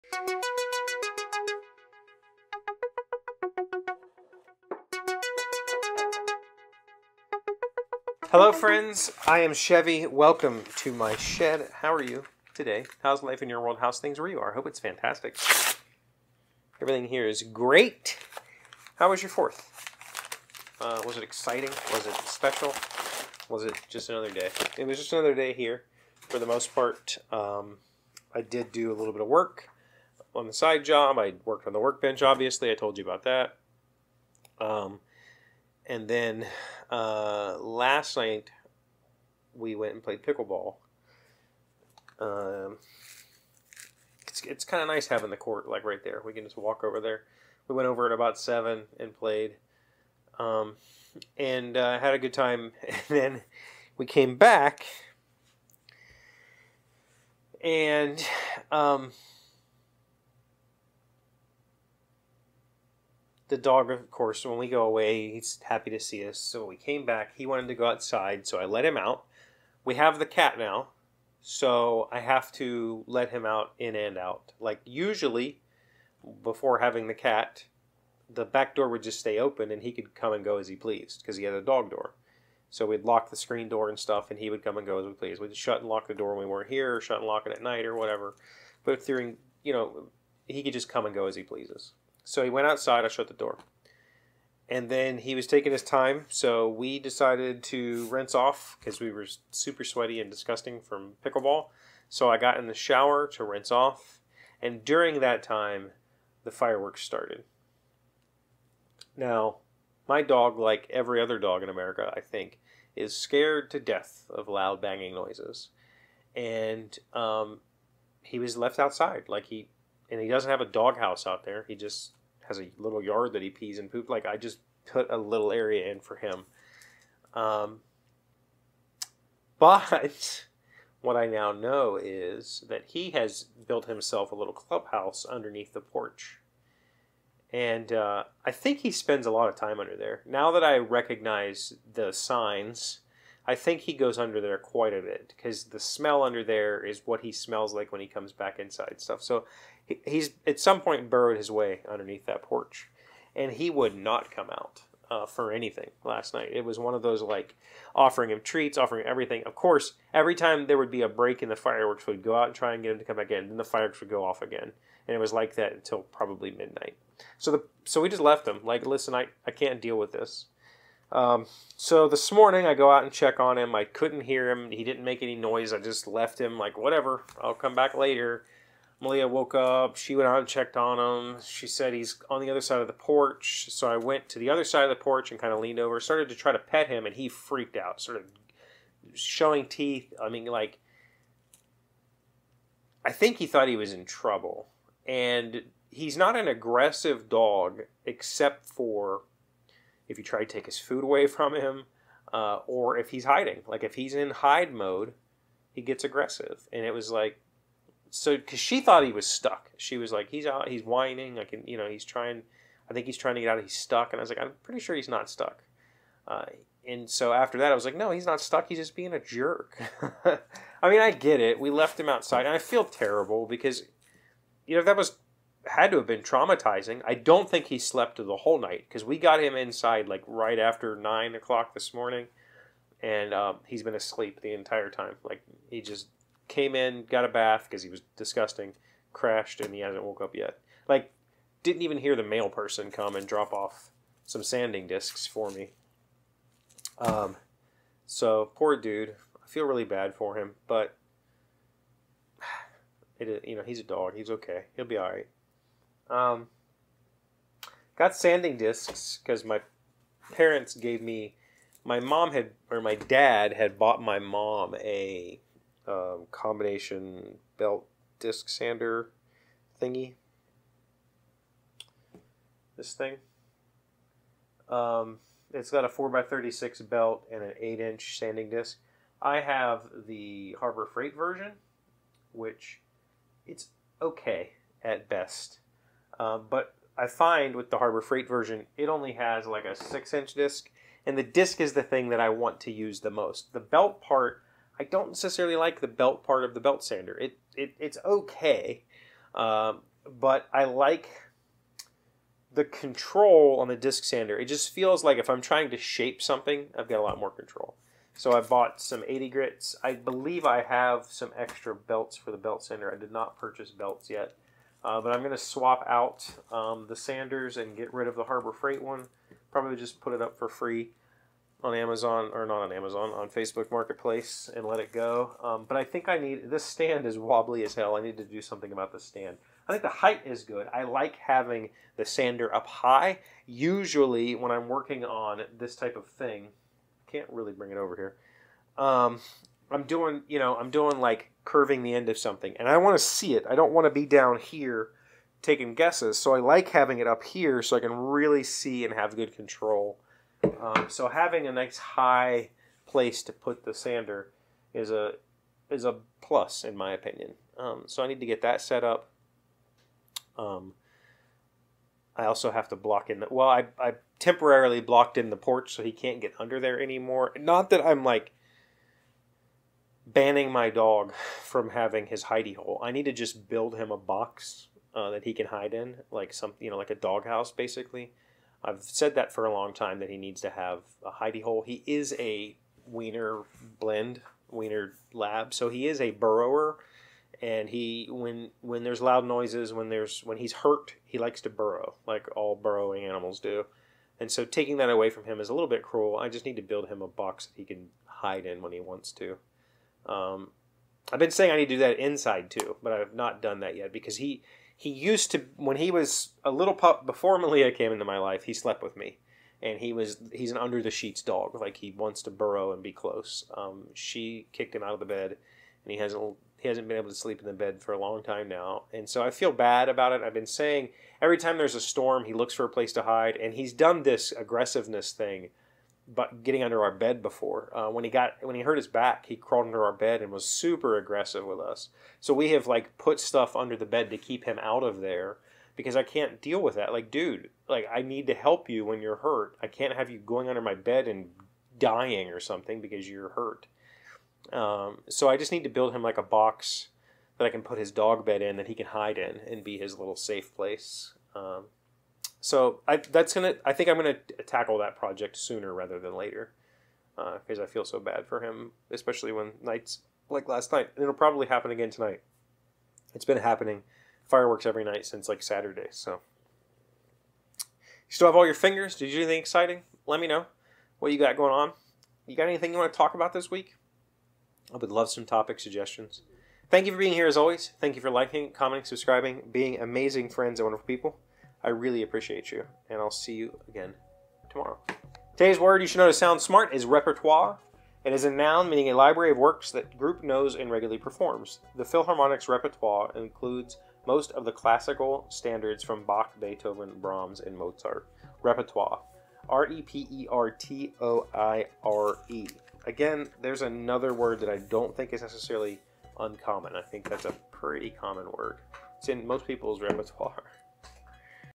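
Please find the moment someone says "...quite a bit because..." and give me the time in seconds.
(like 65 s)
144 s.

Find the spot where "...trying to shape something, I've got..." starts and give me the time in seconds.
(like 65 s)
305 s.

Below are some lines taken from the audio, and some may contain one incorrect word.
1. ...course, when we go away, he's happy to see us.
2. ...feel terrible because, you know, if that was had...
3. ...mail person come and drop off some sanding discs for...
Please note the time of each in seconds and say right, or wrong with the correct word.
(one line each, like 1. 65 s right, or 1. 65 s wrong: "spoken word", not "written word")
1. 64 s right
2. 222 s right
3. 242 s right.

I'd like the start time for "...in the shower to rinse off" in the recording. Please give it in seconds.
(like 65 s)
102 s.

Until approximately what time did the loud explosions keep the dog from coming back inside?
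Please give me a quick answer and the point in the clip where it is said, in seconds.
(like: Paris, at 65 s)
Midnight, at 166 s.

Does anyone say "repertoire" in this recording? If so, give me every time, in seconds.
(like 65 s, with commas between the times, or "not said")
486 s, 492 s, 498 s, 509 s.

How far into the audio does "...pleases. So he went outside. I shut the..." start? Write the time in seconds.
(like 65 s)
91 s.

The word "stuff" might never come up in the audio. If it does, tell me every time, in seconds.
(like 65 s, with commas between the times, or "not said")
83 s, 149 s, 433 s.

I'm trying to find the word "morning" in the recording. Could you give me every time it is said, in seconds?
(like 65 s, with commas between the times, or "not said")
172 s, 231 s.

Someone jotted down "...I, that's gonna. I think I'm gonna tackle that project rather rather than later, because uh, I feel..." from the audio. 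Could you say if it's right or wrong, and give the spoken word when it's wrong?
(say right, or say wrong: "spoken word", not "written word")
wrong: "sooner", not "rather".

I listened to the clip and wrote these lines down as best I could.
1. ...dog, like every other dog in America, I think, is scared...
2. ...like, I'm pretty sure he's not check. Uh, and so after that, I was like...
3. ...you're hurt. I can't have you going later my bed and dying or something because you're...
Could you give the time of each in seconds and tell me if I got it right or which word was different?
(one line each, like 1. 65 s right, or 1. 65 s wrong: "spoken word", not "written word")
1. 110 s right
2. 214 s wrong: "stuck", not "check"
3. 439 s wrong: "under", not "later".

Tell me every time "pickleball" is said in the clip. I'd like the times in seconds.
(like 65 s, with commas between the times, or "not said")
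40 s, 101 s.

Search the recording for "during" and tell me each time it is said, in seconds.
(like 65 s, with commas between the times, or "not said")
89 s, 104 s.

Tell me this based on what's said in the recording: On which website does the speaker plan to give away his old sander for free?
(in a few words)
Facebook Marketplace.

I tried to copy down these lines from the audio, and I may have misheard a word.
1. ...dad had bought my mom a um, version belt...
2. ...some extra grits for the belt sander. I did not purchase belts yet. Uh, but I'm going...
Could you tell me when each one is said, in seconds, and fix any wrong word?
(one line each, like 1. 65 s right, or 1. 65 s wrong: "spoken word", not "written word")
1. 262 s wrong: "combination", not "version"
2. 311 s wrong: "belts", not "grits".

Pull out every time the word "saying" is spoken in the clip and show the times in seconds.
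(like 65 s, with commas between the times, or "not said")
401 s, 420 s.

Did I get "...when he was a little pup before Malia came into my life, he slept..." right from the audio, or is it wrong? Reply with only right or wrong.
right.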